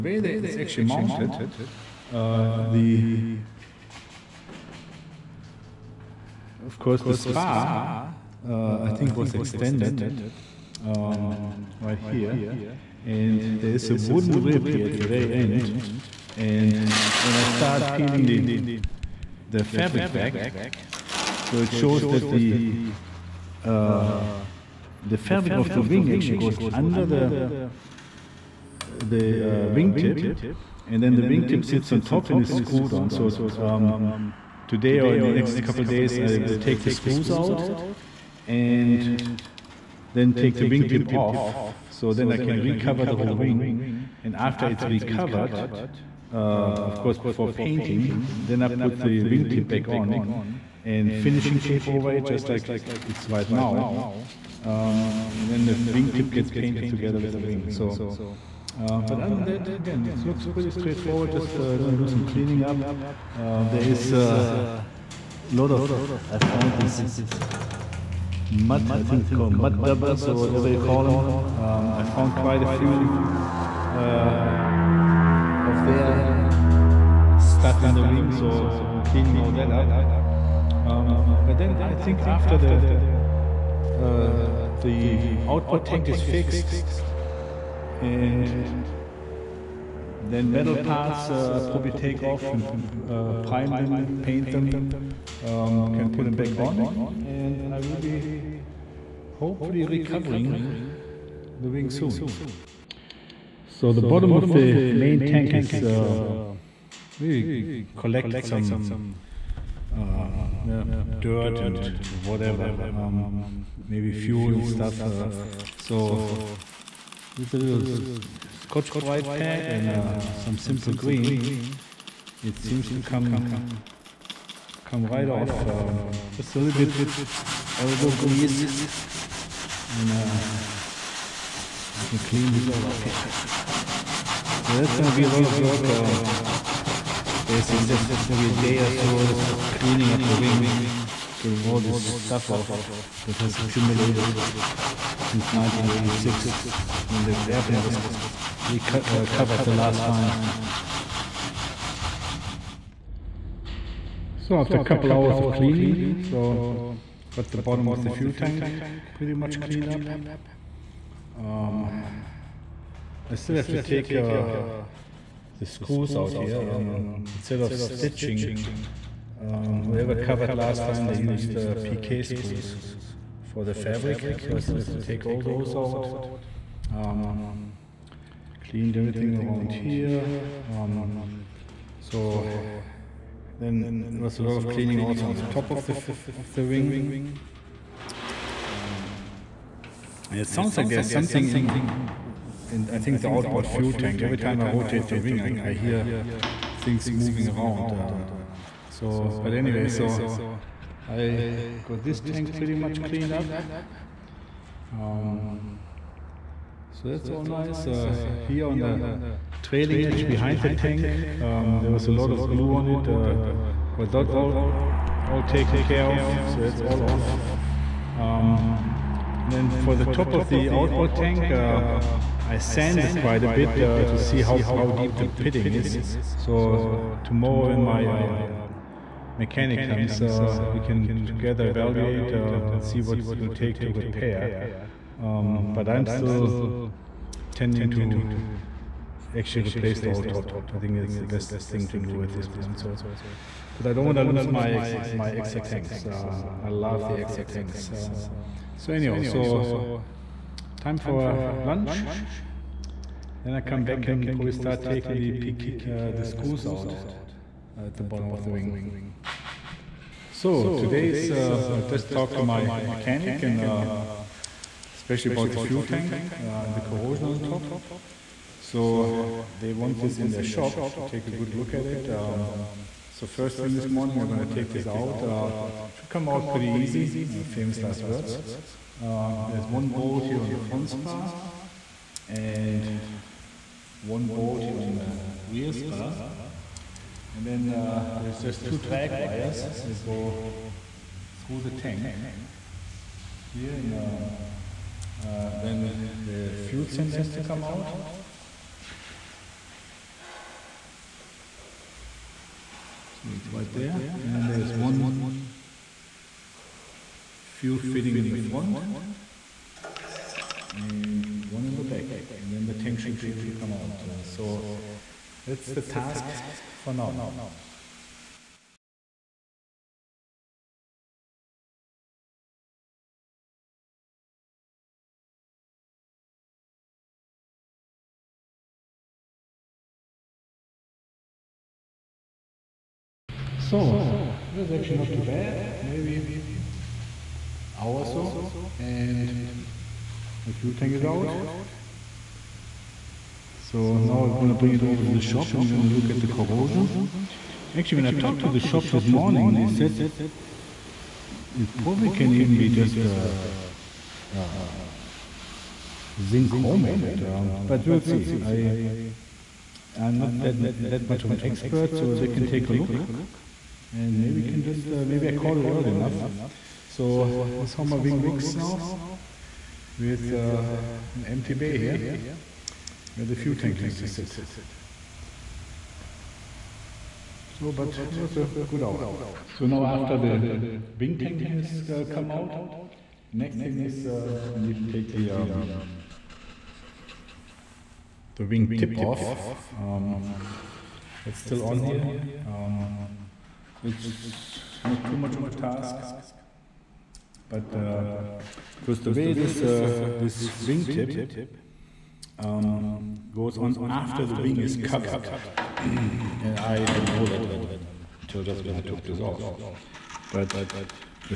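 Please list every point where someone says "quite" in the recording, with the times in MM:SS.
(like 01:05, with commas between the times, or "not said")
01:12, 03:43.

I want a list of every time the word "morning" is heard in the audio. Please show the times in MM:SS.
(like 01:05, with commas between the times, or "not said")
04:33, 05:49.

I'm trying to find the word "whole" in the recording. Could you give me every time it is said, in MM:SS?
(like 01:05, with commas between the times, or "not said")
00:43, 04:00.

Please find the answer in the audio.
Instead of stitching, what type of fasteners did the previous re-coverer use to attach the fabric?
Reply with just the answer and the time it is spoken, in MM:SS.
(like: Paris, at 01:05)
PK screws, at 02:51.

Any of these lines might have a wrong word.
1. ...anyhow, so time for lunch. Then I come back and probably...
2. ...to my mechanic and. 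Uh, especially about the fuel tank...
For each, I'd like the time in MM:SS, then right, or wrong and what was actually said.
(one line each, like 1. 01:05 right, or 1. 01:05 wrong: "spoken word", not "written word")
1. 04:08 right
2. 04:22 right.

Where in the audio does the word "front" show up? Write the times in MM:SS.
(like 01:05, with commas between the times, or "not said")
04:40, 05:08.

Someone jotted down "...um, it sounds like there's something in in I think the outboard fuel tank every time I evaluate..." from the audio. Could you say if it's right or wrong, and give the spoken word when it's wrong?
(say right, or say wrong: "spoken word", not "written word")
wrong: "rotate", not "evaluate".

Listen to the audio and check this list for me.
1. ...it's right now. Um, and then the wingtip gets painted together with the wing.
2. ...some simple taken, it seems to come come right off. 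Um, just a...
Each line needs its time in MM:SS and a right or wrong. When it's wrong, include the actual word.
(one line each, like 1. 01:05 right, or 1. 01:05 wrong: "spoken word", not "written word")
1. 00:53 right
2. 02:00 wrong: "green", not "taken".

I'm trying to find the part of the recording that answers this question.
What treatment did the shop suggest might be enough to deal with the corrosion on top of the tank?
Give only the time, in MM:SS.
05:56.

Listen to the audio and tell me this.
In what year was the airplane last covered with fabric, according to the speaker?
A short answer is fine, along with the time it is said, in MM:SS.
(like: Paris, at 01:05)
1986, at 02:25.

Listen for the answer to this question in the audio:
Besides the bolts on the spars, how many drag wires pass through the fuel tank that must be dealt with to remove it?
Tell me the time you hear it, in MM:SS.
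04:48.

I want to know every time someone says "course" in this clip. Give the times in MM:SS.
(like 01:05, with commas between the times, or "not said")
00:06, 00:46.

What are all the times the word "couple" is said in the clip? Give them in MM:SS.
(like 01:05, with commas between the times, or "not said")
00:35, 02:34.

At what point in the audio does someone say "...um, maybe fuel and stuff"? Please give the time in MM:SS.
01:52.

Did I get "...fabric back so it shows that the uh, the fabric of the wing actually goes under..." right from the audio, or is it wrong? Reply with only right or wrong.
right.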